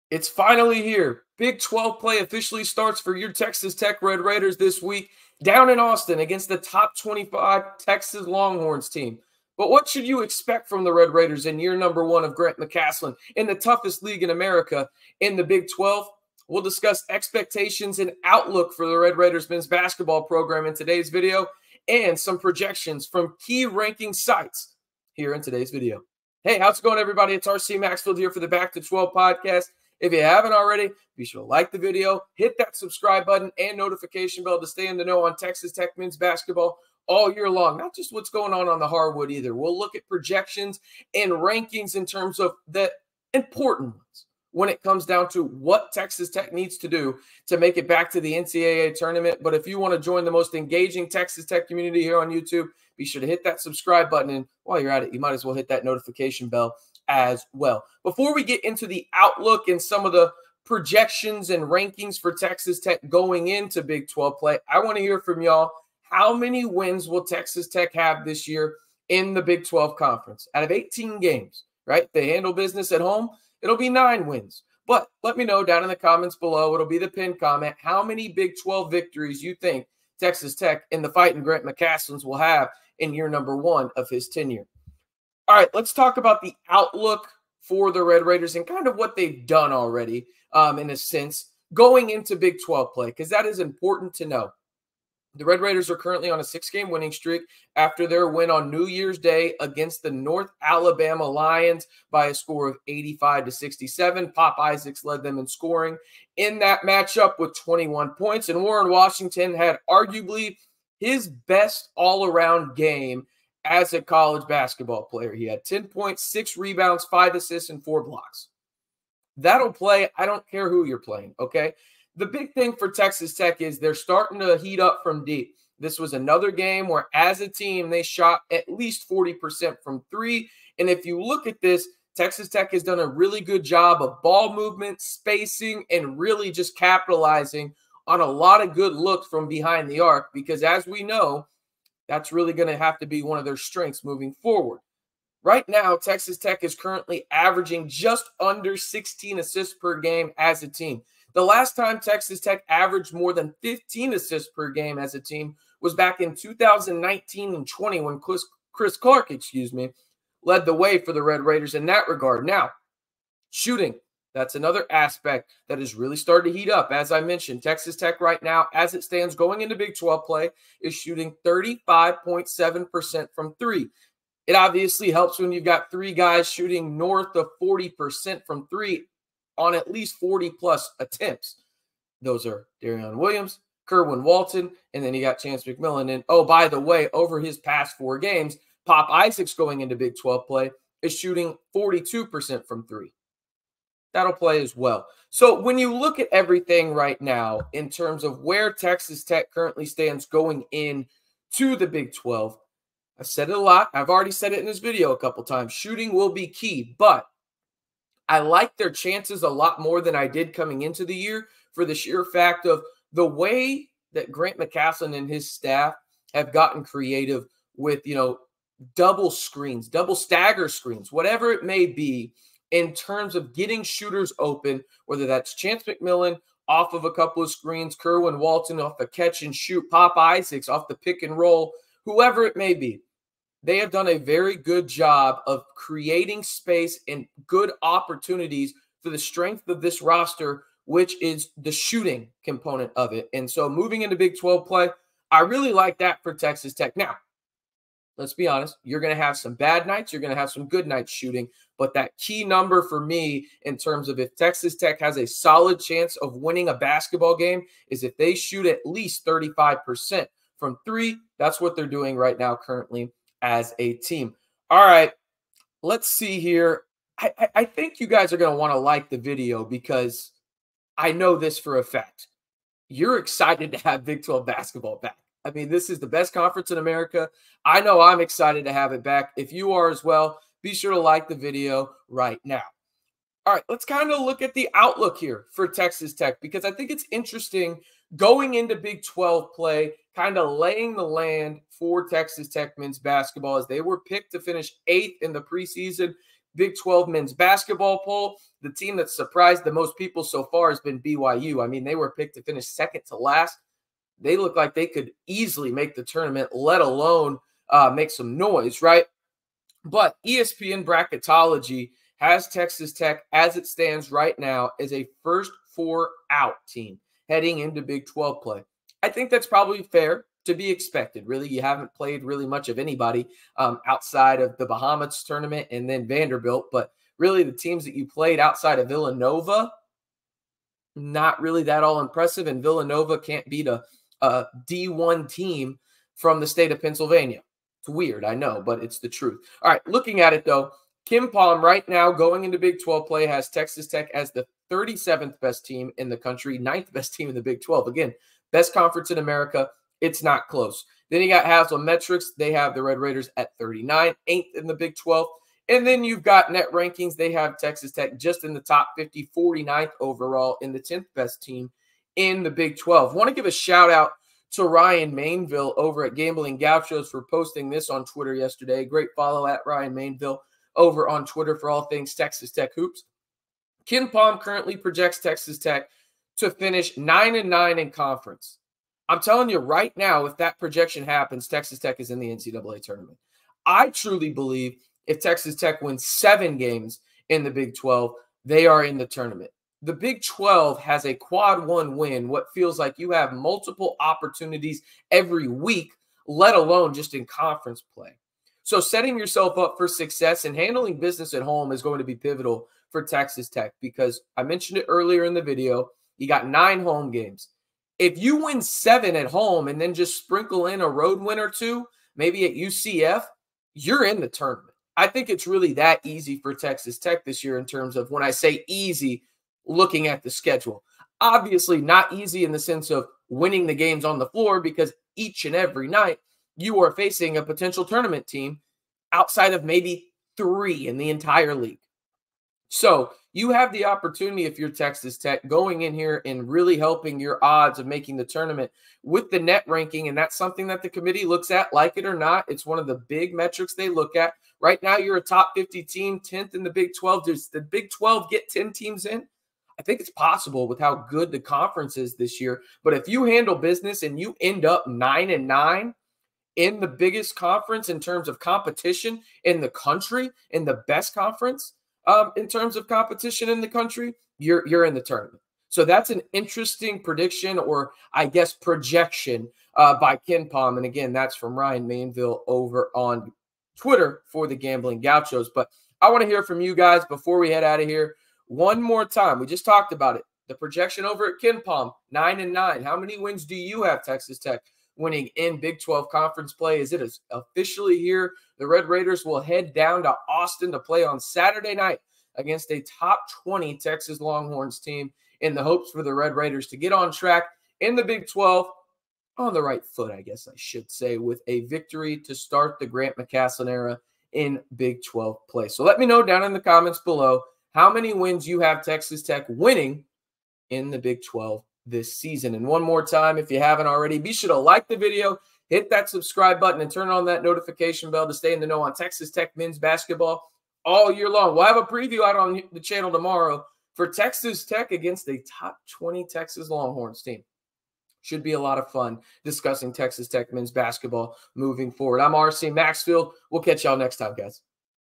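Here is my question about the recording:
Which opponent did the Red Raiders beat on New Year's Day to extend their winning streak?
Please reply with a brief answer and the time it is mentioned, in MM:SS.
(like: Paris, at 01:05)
North Alabama Lions, at 01:40.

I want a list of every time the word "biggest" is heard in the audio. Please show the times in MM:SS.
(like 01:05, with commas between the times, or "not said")
07:36.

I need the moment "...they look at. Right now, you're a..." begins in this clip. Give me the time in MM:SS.
07:23.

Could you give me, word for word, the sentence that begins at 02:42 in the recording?
Now, shooting that's another aspect that is really starting to heat up.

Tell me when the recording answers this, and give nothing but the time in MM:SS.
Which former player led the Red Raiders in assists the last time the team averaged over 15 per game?
02:38.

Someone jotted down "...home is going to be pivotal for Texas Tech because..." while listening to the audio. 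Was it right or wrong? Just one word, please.
right.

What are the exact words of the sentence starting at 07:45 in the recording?
So that's an interesting prediction, or I guess projection uh, by KenPom.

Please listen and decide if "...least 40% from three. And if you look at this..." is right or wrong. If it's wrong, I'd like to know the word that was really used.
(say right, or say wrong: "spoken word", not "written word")
right.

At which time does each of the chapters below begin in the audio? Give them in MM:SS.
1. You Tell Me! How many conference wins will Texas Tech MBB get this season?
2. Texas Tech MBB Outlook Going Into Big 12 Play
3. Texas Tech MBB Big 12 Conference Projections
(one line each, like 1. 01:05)
1. 01:05
2. 01:30
3. 04:45.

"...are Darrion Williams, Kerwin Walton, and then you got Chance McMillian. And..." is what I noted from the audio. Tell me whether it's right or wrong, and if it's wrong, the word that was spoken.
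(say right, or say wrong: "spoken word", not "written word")
right.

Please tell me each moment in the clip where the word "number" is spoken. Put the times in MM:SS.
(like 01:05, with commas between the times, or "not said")
00:11, 01:23, 04:12.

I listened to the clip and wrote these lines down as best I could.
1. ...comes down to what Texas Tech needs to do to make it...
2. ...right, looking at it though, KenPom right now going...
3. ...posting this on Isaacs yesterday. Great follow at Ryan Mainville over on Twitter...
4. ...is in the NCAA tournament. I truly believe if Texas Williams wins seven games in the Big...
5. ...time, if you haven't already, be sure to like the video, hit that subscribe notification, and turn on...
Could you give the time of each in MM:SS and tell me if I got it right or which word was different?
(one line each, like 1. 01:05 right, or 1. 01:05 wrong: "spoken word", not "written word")
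1. 00:44 right
2. 05:39 right
3. 06:07 wrong: "Twitter", not "Isaacs"
4. 06:21 wrong: "Tech", not "Williams"
5. 08:33 wrong: "button", not "notification".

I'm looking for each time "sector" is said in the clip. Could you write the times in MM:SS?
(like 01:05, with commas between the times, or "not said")
not said.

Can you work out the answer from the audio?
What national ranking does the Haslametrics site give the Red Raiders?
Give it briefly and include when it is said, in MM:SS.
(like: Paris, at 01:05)
39, at 05:53.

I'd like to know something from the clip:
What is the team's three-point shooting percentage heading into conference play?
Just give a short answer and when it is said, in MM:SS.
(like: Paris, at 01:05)
35.7%, at 02:51.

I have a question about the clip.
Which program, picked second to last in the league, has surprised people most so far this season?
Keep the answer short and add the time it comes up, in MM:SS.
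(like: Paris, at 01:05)
BYU, at 05:00.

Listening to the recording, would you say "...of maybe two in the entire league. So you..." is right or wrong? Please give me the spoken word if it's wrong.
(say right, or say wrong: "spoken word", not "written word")
wrong: "three", not "two".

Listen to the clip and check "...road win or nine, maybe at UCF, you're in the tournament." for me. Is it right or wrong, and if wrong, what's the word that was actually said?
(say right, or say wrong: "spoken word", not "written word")
wrong: "two", not "nine".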